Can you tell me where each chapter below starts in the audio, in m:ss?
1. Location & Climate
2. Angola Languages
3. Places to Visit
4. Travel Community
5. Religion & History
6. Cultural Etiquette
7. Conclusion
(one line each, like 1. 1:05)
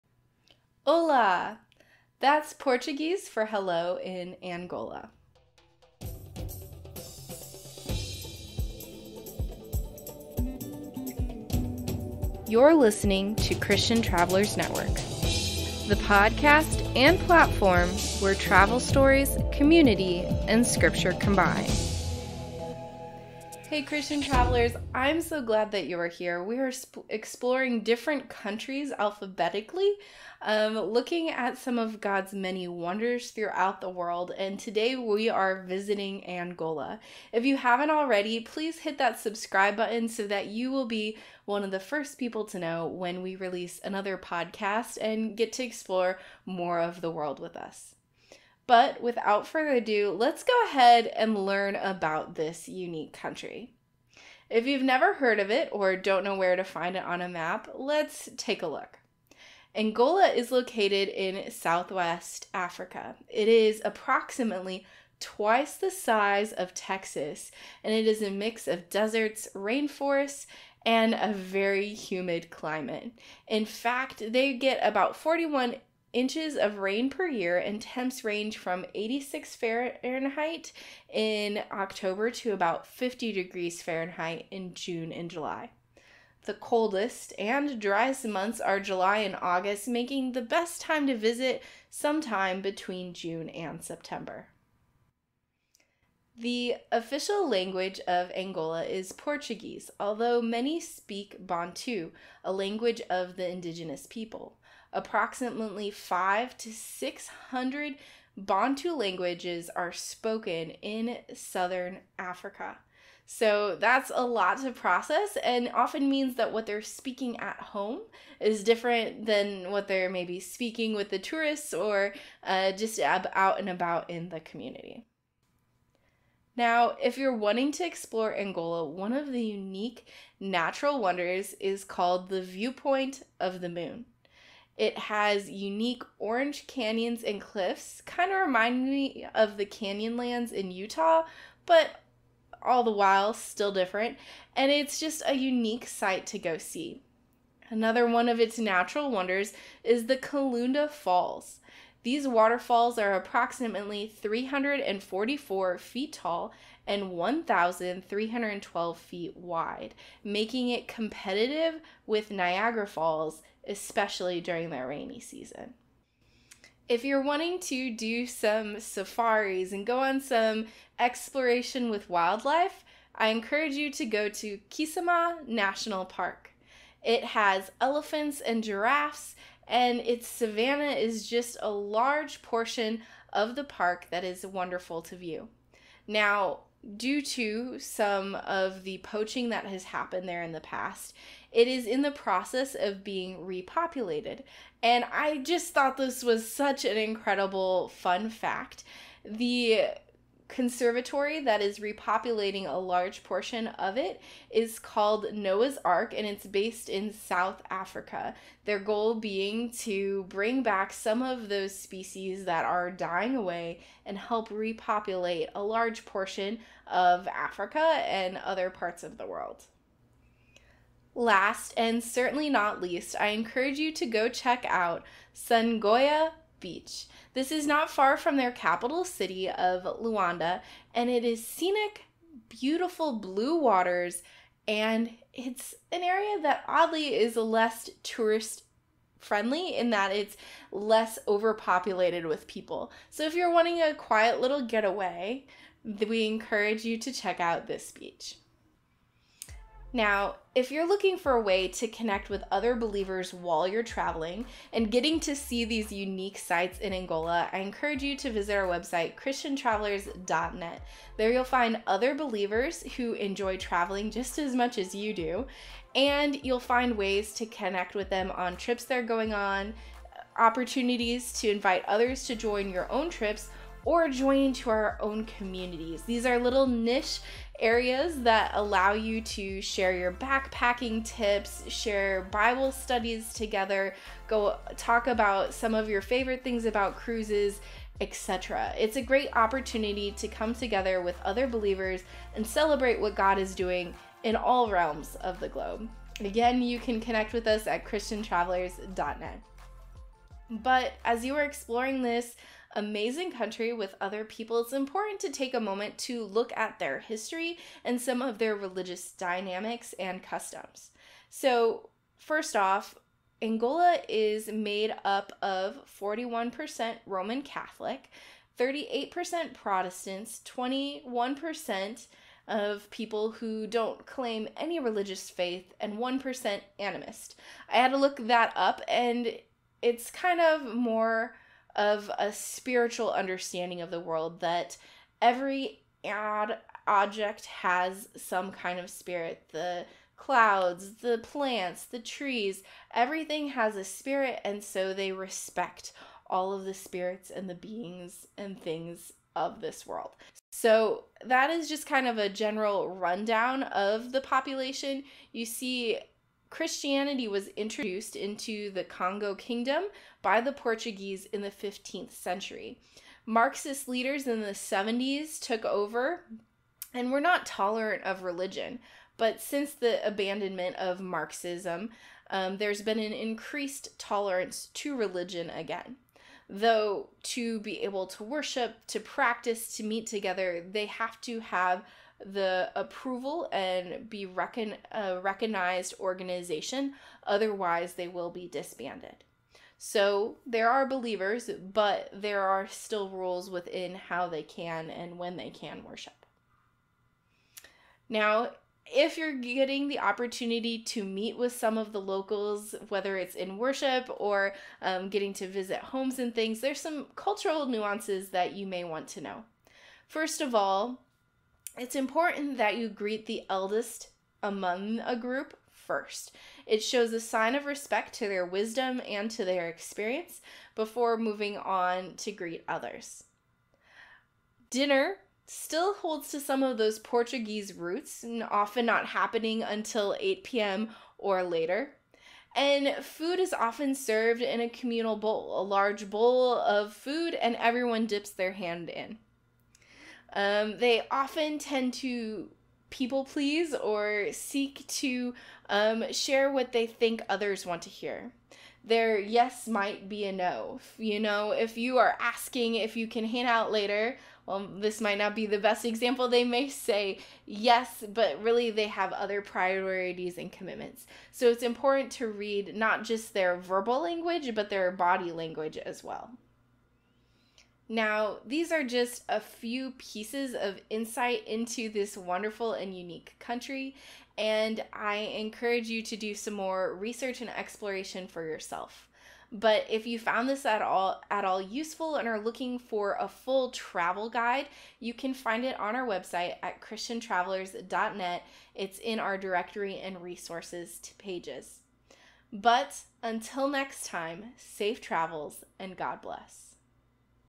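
1. 0:49
2. 1:37
3. 2:05
4. 4:09
5. 5:00
6. 6:40
7. 7:47.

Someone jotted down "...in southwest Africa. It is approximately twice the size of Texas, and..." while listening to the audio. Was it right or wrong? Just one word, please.
right.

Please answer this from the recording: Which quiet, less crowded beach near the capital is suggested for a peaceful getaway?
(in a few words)
Sungoya Beach.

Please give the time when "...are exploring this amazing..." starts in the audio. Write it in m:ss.
5:01.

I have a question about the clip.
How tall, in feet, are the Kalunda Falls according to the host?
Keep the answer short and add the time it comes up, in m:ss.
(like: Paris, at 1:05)
344 feet, at 2:34.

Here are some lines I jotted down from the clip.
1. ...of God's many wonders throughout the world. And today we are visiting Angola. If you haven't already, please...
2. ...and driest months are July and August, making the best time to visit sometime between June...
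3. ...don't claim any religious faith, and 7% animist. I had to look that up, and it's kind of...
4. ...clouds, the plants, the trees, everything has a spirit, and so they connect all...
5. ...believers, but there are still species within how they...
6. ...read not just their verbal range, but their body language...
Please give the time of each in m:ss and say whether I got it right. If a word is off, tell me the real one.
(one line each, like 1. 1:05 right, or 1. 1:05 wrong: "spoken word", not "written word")
1. 0:31 right
2. 1:27 right
3. 5:23 wrong: "1", not "7"
4. 5:40 wrong: "respect", not "connect"
5. 6:30 wrong: "rules", not "species"
6. 7:42 wrong: "language", not "range".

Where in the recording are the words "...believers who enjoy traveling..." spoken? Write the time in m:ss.
4:22.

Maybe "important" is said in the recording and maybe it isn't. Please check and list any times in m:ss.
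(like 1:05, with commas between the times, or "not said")
5:04, 6:51, 7:41.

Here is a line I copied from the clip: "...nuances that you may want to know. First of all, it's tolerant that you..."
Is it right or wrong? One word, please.
wrong.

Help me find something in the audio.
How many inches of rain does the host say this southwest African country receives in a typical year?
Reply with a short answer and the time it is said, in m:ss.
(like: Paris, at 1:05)
41 inches, at 1:15.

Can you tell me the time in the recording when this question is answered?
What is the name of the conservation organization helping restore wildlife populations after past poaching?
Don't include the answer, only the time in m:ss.
3:25.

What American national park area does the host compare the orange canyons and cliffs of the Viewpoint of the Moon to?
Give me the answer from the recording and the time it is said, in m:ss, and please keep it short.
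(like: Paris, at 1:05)
Canyonlands in Utah, at 2:19.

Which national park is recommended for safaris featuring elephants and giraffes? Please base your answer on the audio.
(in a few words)
Kisama National Park.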